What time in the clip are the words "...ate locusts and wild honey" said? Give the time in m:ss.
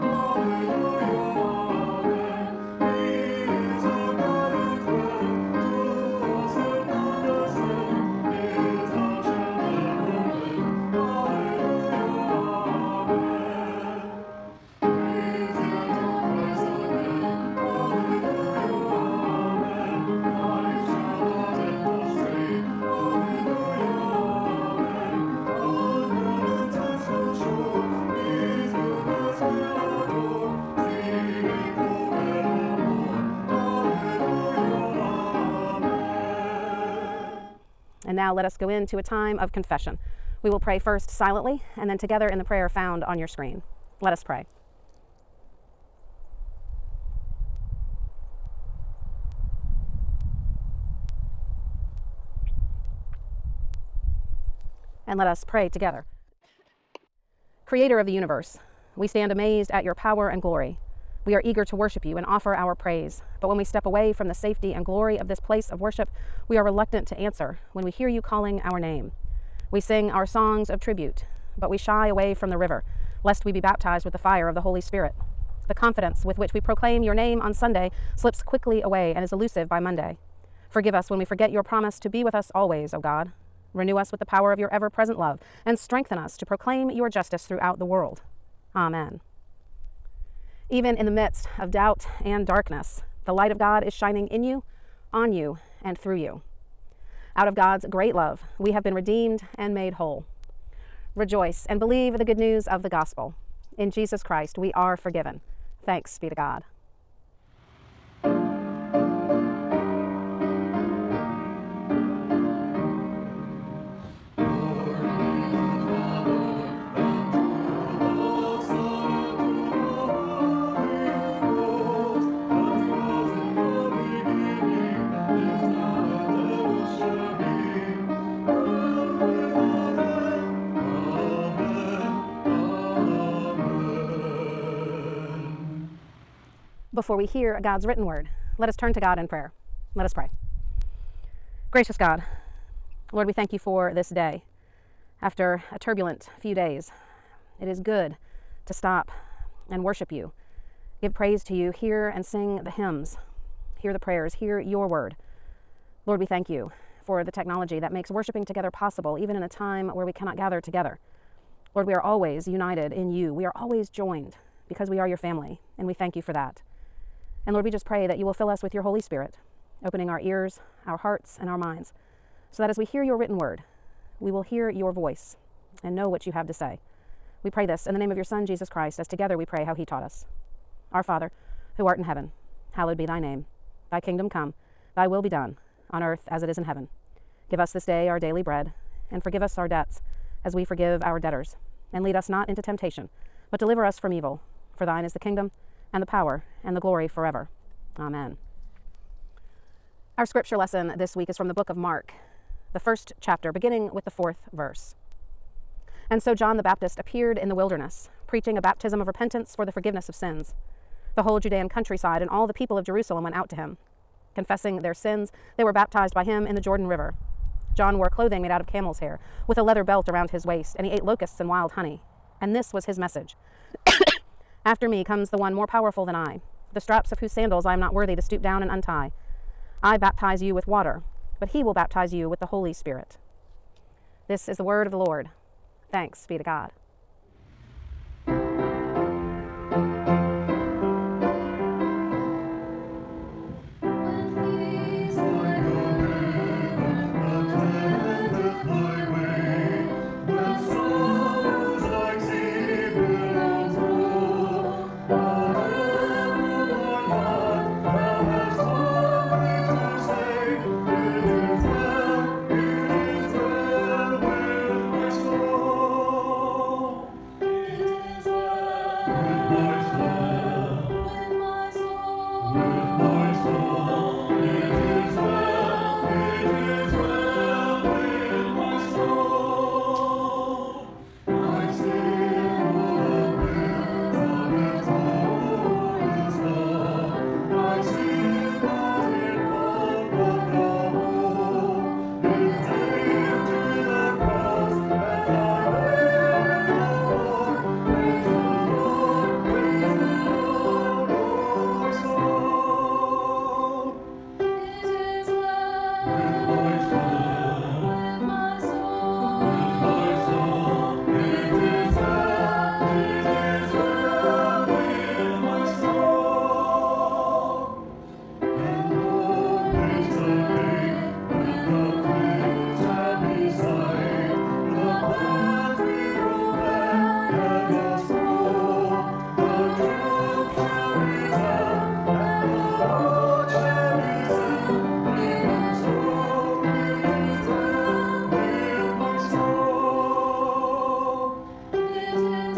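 3:40.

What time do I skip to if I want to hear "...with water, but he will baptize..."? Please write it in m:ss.
3:50.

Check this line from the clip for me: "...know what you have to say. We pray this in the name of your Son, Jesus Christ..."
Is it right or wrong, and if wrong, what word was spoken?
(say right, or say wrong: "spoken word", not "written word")
right.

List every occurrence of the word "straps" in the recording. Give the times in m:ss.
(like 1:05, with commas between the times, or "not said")
3:46.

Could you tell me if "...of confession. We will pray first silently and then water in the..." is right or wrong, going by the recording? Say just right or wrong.
wrong.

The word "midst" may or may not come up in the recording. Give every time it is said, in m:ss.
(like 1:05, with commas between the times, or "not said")
1:31.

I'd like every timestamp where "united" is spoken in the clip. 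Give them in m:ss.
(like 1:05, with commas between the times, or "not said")
2:42.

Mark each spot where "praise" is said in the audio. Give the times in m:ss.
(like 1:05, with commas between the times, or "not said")
1:02, 2:31.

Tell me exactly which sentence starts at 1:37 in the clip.
Out of God's great love, we have been redeemed and made whole.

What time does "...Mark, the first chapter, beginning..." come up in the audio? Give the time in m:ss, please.
3:21.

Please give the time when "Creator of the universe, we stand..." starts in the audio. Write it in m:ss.
0:57.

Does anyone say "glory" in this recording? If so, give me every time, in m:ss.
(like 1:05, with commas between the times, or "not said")
1:00, 1:04, 3:16.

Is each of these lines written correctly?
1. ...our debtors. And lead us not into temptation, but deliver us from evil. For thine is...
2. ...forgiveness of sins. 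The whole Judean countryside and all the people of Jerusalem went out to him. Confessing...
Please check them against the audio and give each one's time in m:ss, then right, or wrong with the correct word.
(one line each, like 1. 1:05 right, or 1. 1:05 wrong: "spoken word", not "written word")
1. 3:11 right
2. 3:29 right.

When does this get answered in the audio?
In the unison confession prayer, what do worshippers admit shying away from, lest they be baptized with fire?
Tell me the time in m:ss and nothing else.
1:12.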